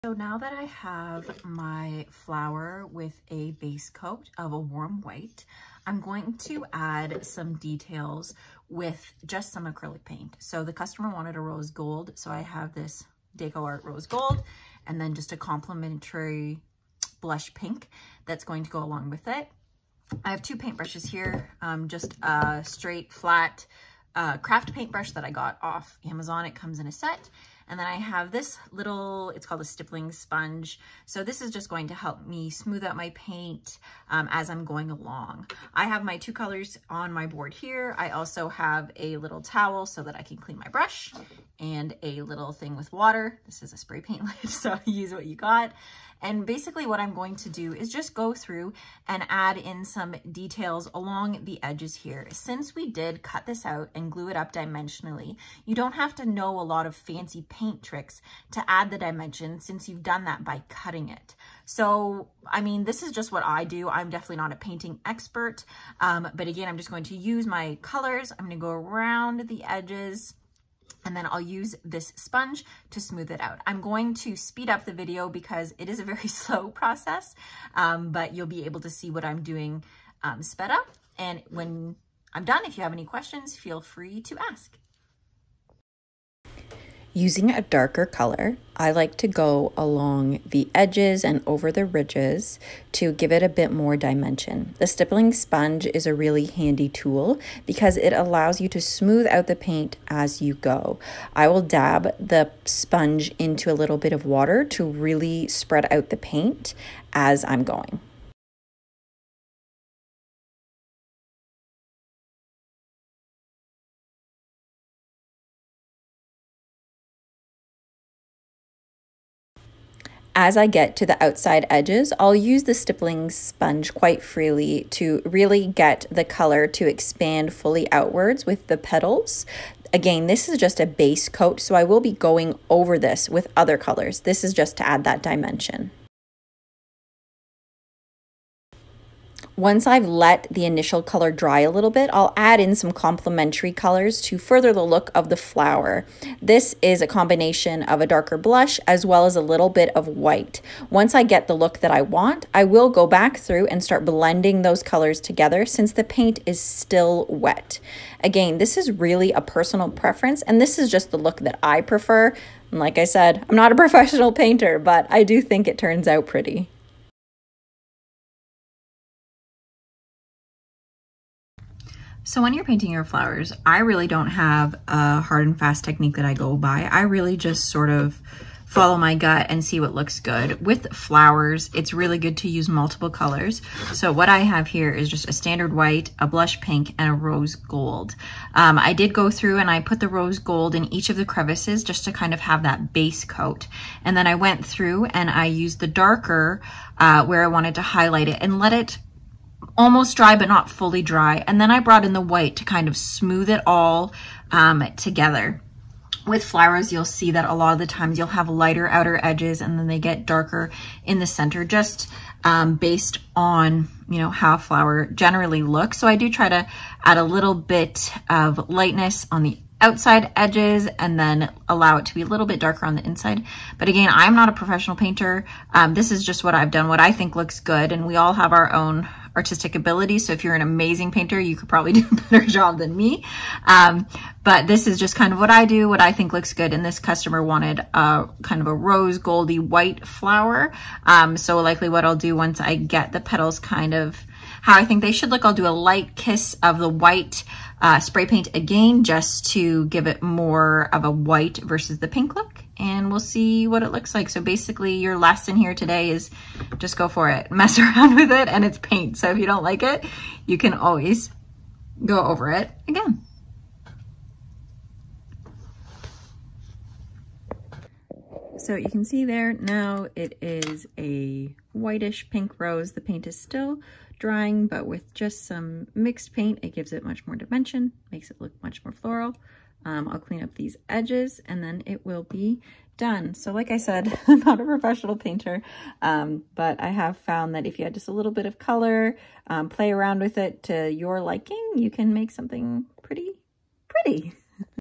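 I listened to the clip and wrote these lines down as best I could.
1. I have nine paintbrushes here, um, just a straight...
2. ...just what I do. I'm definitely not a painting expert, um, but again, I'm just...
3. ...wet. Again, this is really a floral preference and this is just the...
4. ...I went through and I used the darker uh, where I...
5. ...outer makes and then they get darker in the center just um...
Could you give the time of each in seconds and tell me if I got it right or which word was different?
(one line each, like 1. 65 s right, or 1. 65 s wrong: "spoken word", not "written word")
1. 20 s wrong: "two", not "nine"
2. 63 s right
3. 157 s wrong: "personal", not "floral"
4. 194 s right
5. 208 s wrong: "edges", not "makes".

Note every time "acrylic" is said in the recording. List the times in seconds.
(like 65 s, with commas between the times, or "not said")
9 s.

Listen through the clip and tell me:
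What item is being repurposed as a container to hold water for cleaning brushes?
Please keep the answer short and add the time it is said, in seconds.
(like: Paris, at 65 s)
spray paint lid, at 43 s.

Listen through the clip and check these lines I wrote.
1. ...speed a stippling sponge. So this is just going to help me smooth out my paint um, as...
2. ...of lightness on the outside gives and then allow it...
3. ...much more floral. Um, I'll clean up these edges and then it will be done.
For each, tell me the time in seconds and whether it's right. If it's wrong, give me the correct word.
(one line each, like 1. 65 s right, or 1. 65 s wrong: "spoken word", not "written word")
1. 29 s wrong: "called", not "speed"
2. 218 s wrong: "edges", not "gives"
3. 278 s right.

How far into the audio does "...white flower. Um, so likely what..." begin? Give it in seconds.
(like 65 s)
239 s.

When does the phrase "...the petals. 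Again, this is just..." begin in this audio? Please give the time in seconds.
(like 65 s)
128 s.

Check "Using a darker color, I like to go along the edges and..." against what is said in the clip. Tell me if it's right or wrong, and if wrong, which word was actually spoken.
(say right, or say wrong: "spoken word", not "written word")
right.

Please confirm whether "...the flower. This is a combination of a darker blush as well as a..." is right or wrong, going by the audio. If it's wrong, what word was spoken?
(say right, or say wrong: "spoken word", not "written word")
right.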